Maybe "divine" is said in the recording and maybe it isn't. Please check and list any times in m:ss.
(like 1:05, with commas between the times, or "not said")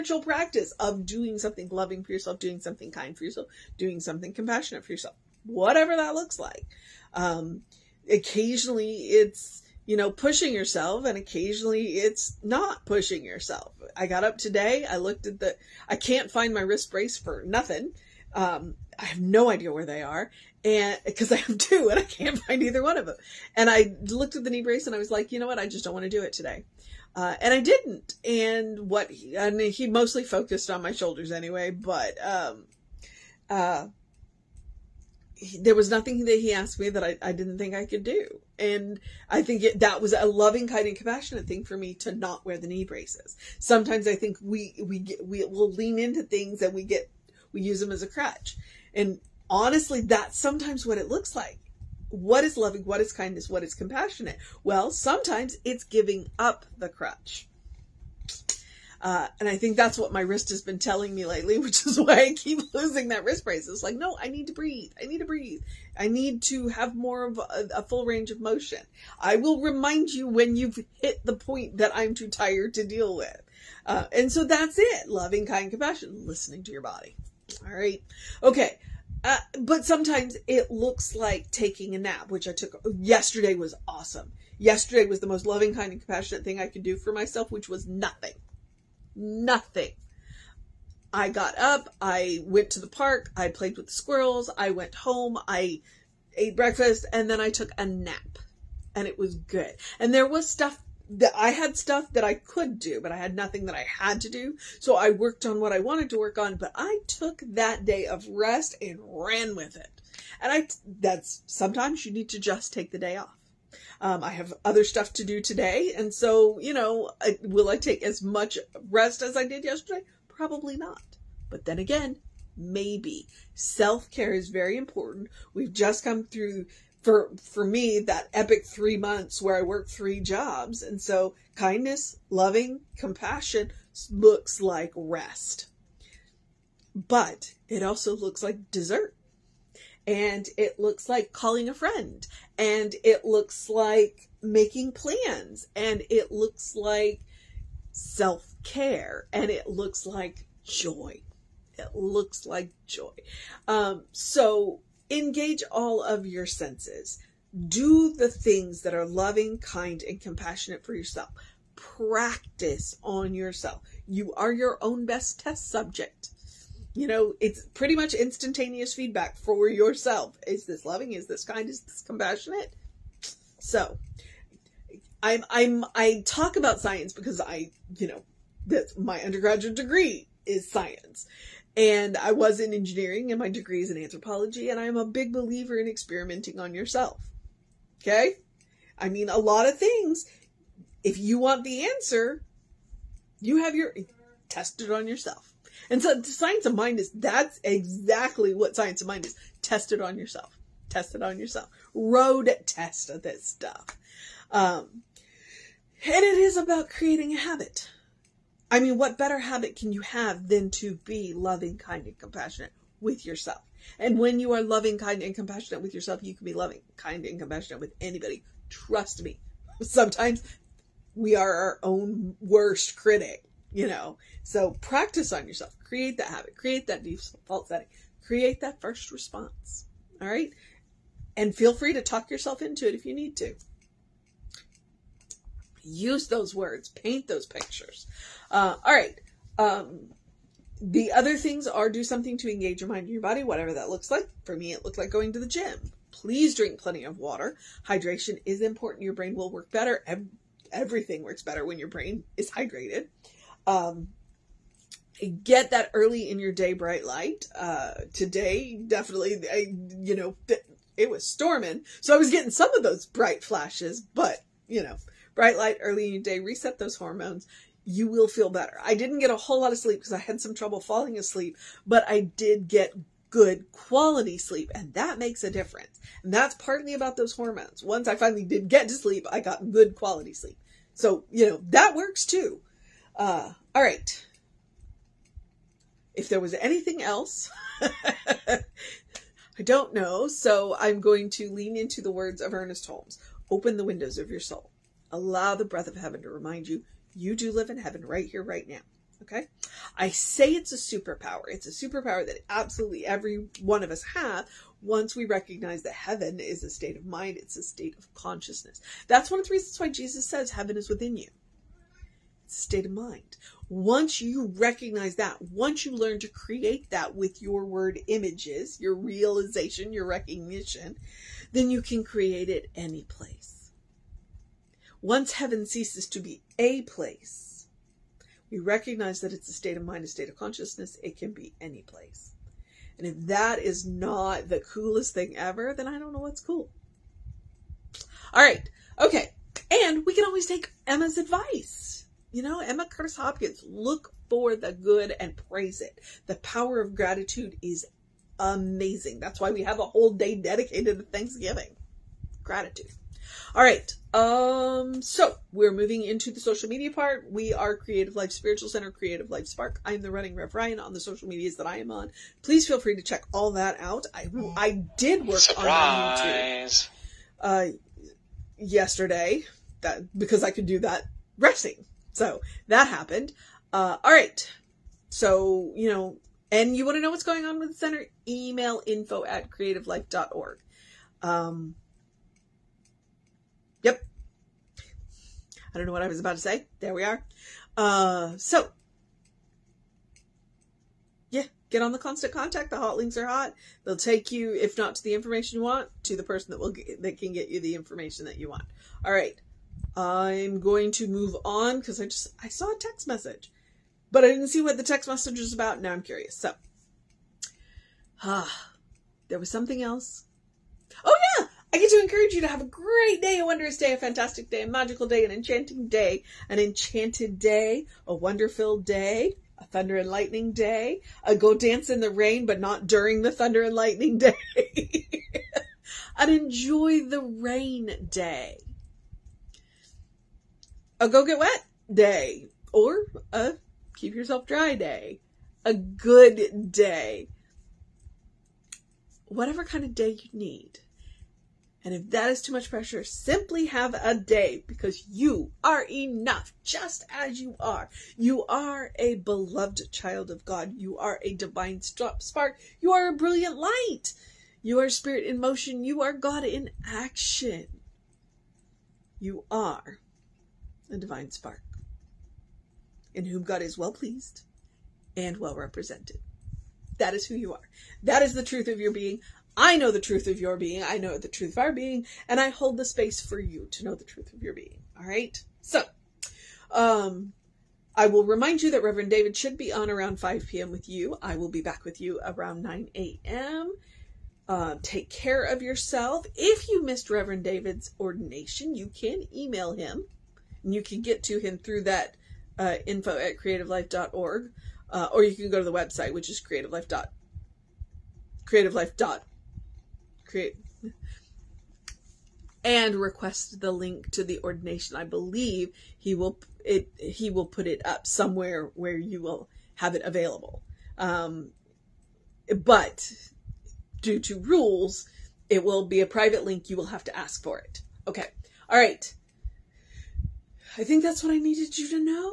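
7:31, 7:40.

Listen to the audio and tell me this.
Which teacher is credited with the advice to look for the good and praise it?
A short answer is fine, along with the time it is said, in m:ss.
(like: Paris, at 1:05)
Emma Curtis Hopkins, at 5:42.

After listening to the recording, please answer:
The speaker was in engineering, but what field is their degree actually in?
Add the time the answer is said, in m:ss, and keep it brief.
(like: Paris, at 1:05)
Anthropology, at 3:04.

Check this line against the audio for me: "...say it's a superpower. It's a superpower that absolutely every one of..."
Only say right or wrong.
right.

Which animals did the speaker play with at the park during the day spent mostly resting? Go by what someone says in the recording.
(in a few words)
Squirrels.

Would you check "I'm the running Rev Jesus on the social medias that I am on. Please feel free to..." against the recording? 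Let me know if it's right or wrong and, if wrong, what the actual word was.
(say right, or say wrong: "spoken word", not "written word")
wrong: "Ryan", not "Jesus".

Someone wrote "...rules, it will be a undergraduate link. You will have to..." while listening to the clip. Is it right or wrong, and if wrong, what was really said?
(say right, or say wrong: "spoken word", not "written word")
wrong: "private", not "undergraduate".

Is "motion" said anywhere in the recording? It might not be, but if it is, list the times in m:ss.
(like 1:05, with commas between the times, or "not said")
1:08, 7:35.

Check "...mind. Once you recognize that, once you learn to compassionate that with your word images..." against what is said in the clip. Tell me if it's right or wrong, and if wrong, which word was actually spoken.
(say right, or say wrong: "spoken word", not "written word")
wrong: "create", not "compassionate".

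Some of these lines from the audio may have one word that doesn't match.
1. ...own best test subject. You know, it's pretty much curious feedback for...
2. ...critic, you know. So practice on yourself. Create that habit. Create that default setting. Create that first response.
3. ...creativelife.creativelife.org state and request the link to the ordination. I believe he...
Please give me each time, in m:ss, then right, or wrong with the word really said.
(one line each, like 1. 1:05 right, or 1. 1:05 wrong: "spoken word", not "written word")
1. 2:44 wrong: "instantaneous", not "curious"
2. 3:42 right
3. 8:16 wrong: "create", not "state".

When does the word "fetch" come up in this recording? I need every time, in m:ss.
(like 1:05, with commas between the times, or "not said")
not said.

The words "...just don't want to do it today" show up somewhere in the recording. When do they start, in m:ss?
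0:25.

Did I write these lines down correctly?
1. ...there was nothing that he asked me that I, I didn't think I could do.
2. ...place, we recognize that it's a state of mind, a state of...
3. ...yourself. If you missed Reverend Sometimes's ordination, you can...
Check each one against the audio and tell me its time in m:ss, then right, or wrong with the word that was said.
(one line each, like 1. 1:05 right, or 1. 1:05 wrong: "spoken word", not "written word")
1. 0:35 right
2. 5:26 right
3. 8:05 wrong: "David", not "Sometimes".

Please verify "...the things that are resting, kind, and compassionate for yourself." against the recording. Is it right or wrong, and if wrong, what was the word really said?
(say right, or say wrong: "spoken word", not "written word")
wrong: "loving", not "resting".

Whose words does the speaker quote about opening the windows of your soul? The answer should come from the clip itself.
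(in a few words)
Ernest Holmes.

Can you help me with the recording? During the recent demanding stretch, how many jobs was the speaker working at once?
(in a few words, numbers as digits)
3.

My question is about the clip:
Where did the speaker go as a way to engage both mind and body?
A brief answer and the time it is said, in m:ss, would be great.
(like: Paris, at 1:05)
The gym, at 4:05.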